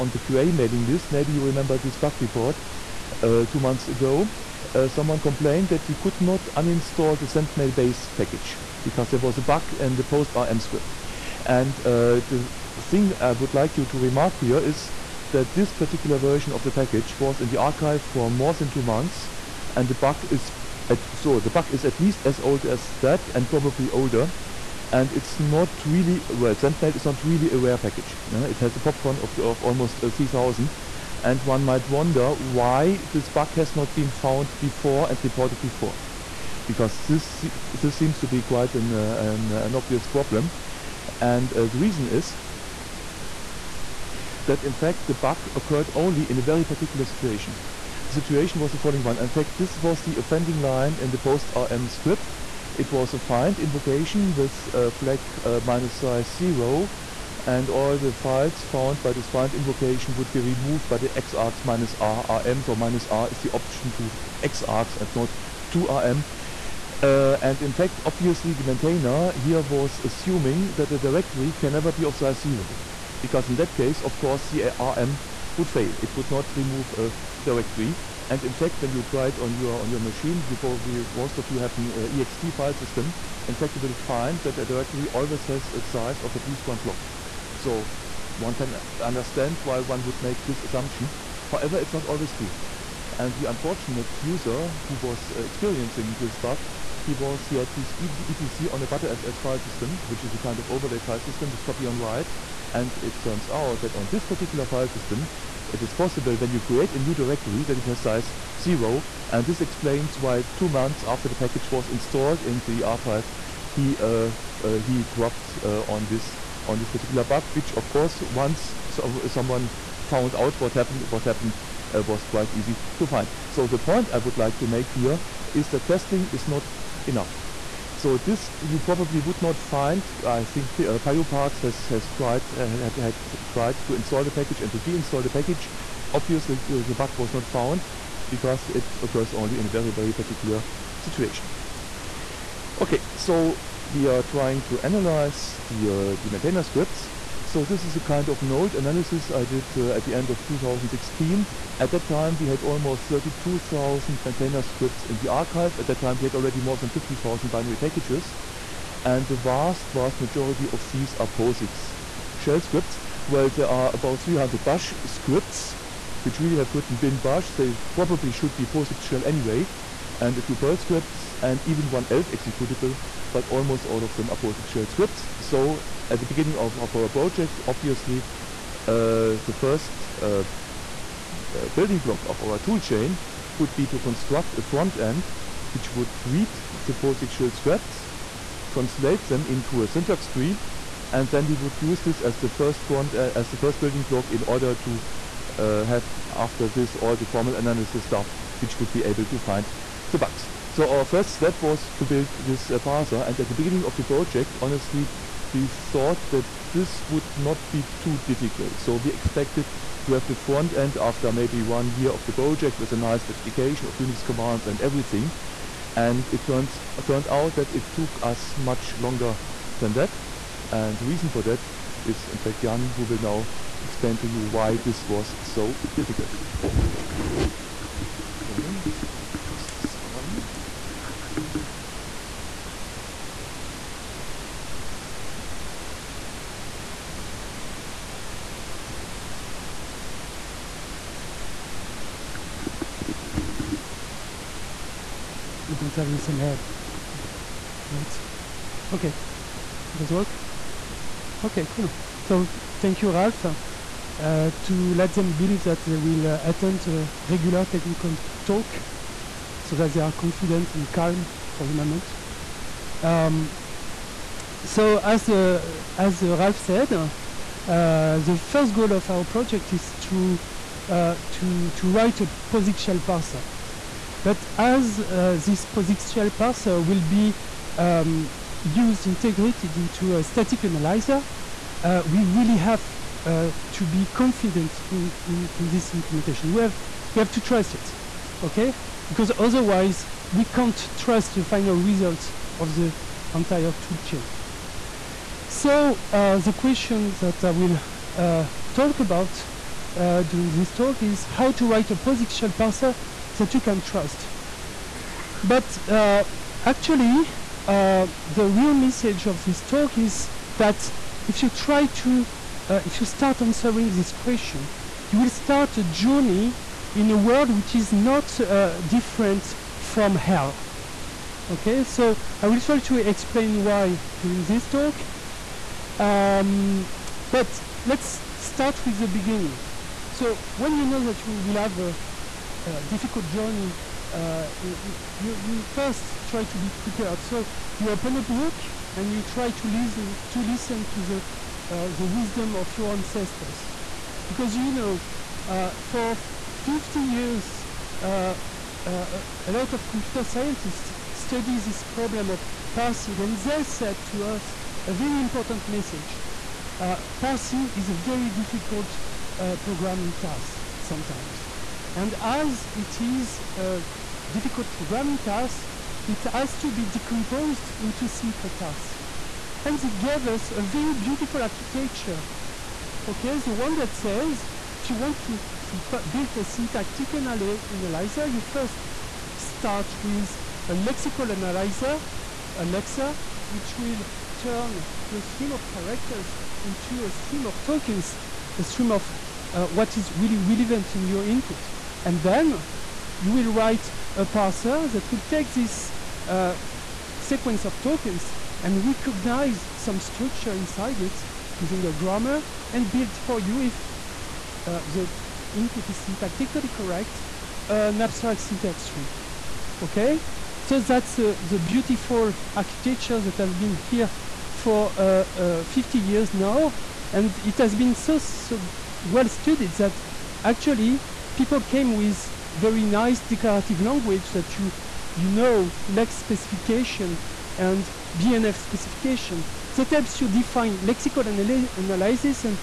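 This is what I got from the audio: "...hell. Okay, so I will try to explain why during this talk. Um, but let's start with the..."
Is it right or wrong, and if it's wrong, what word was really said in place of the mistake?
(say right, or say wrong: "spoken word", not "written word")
right.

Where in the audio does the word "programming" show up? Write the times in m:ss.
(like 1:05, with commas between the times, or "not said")
5:59, 6:04.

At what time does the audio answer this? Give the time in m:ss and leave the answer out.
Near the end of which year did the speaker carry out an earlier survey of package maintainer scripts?
2:30.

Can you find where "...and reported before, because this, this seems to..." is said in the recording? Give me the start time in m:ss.
0:35.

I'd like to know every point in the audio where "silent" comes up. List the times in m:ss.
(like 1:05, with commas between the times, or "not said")
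not said.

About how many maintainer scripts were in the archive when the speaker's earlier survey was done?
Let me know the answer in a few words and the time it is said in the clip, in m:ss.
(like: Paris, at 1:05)
almost 32,000, at 2:32.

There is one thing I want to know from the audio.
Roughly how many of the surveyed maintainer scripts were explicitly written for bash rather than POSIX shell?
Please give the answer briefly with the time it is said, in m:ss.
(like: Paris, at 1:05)
about 300, at 2:43.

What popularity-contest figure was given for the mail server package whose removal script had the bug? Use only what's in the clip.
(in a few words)
almost 3,000.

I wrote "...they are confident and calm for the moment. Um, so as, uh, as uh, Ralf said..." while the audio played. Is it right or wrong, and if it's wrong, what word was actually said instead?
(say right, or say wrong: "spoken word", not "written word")
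right.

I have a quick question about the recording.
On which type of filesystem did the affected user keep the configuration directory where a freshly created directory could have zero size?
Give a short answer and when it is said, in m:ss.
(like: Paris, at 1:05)
Btrfs, at 1:38.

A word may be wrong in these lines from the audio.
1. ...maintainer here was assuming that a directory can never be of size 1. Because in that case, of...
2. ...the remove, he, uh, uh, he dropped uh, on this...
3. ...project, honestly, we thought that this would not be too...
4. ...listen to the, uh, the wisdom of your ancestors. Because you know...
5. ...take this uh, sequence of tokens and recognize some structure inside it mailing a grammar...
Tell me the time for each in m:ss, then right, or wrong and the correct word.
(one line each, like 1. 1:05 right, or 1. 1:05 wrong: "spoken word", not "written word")
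1. 1:08 wrong: "0", not "1"
2. 1:52 wrong: "archive", not "remove"
3. 3:24 right
4. 5:40 right
5. 6:35 wrong: "using", not "mailing".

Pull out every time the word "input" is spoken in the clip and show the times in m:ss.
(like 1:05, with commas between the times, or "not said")
6:31, 6:45.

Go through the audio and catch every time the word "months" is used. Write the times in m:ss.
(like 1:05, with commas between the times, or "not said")
0:03, 0:18, 1:50.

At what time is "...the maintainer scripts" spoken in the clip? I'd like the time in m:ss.
2:26.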